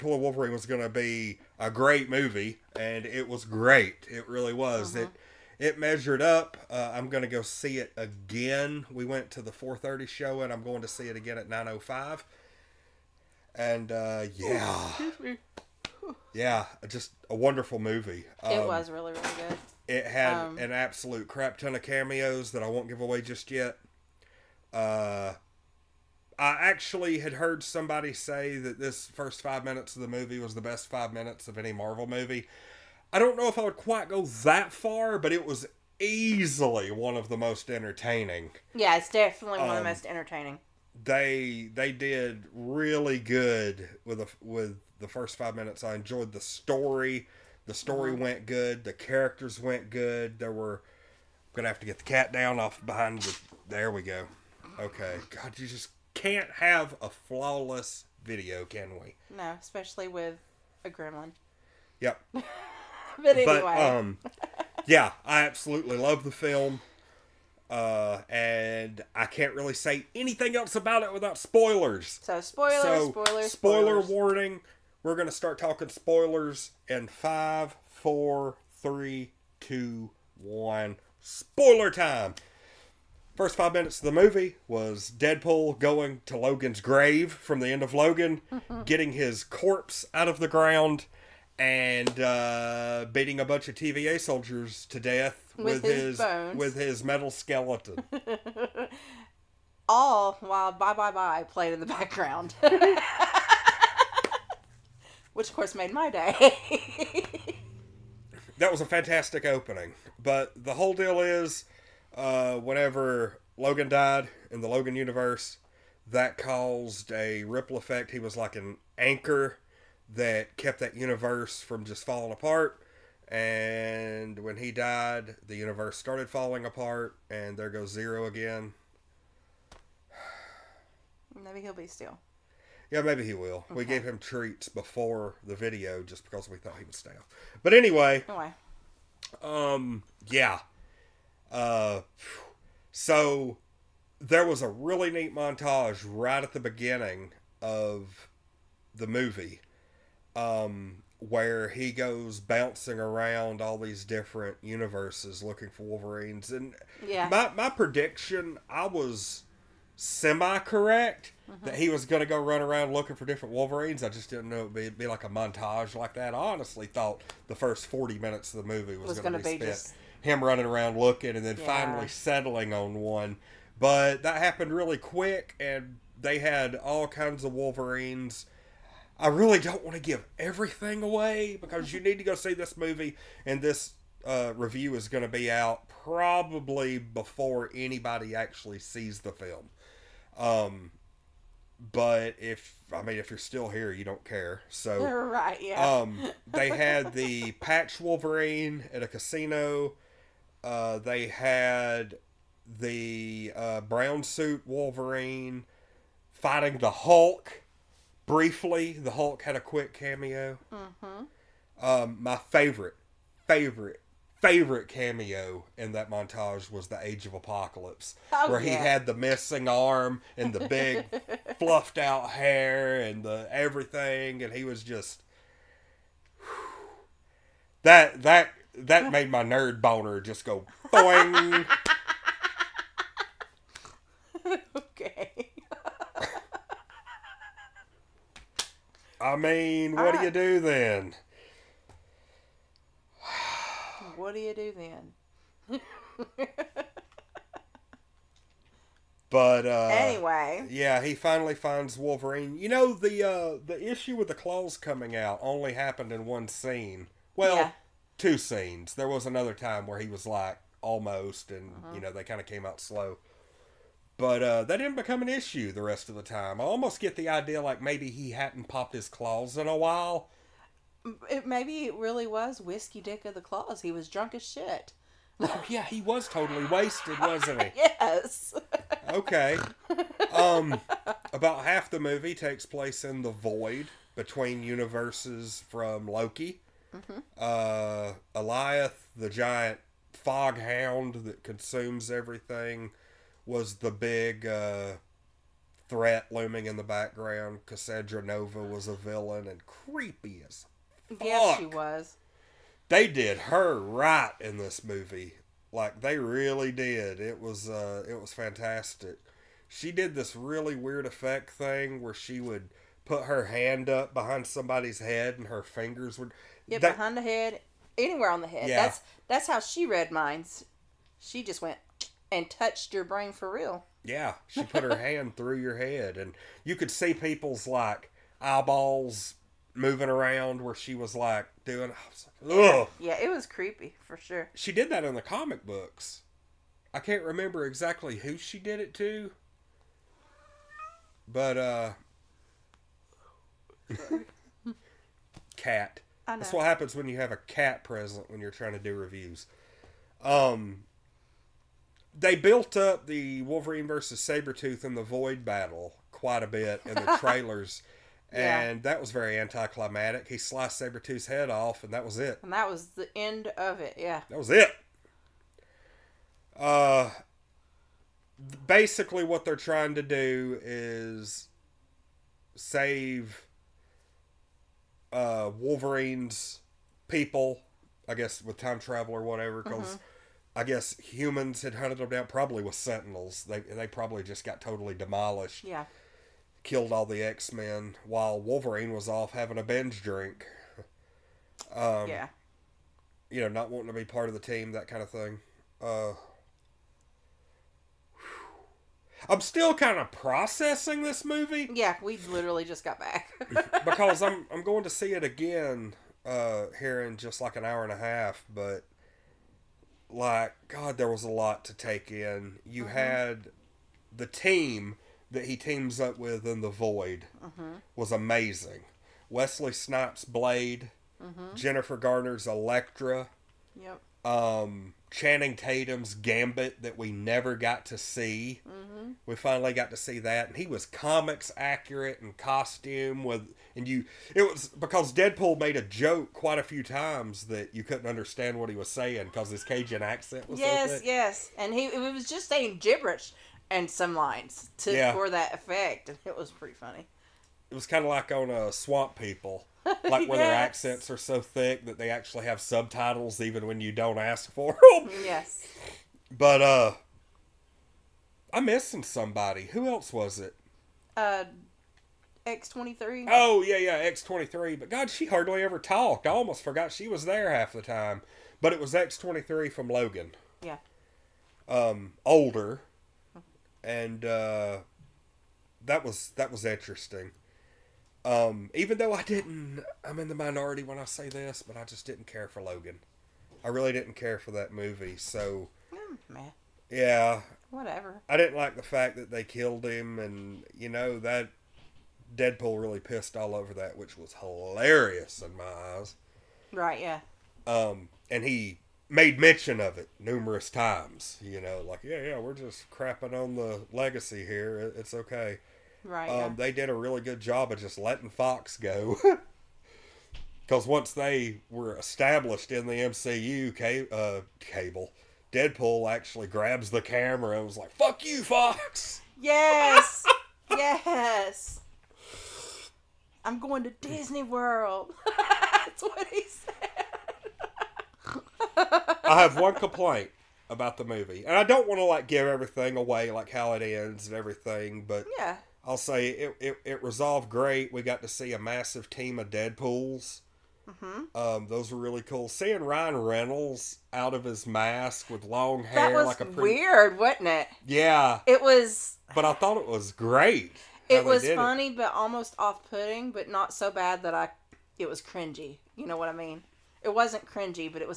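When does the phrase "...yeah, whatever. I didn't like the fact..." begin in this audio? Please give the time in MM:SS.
08:06.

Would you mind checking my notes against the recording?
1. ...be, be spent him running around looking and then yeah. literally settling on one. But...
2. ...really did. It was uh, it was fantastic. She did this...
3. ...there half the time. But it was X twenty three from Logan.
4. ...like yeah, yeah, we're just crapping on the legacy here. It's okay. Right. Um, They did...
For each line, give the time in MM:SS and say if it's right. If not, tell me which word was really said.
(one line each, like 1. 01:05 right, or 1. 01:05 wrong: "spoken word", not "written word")
1. 02:49 wrong: "finally", not "literally"
2. 05:06 right
3. 07:47 right
4. 08:21 right.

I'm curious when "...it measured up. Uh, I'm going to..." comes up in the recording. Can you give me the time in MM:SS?
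00:05.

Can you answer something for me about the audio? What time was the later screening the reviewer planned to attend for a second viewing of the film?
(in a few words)
9:05.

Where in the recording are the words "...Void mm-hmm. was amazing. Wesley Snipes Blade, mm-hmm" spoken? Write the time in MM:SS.
06:56.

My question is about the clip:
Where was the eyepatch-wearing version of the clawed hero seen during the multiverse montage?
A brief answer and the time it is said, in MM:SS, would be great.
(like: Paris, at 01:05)
a casino, at 03:19.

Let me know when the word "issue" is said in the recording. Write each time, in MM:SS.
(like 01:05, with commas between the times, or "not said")
04:13, 04:25.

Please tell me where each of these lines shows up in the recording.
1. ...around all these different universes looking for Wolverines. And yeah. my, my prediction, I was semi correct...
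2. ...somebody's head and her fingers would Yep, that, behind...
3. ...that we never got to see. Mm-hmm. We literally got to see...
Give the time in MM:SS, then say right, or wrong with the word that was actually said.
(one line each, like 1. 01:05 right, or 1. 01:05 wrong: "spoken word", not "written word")
1. 02:32 right
2. 05:14 right
3. 07:06 wrong: "finally", not "literally".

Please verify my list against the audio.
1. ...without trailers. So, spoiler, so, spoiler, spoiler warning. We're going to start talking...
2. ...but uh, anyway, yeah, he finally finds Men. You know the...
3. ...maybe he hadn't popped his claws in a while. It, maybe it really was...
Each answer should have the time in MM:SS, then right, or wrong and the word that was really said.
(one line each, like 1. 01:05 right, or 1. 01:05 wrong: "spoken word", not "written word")
1. 01:11 wrong: "spoilers", not "trailers"
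2. 04:09 wrong: "Wolverine", not "Men"
3. 04:27 right.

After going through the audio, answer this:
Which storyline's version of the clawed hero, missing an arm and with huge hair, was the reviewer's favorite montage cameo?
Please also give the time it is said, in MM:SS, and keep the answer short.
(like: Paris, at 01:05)
Age of Apocalypse, at 03:37.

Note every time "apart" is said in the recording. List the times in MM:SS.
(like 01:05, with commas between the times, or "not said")
02:02, 02:06.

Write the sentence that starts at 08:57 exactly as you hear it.
We got to see a massive team of Deadpools.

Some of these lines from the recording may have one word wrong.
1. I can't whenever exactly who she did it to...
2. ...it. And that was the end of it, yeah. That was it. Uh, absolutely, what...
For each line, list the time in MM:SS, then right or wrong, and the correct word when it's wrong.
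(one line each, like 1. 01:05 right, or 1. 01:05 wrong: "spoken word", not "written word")
1. 05:36 wrong: "remember", not "whenever"
2. 06:02 wrong: "basically", not "absolutely".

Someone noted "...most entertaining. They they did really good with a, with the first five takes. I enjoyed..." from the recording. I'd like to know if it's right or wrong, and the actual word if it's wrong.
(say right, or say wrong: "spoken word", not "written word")
wrong: "minutes", not "takes".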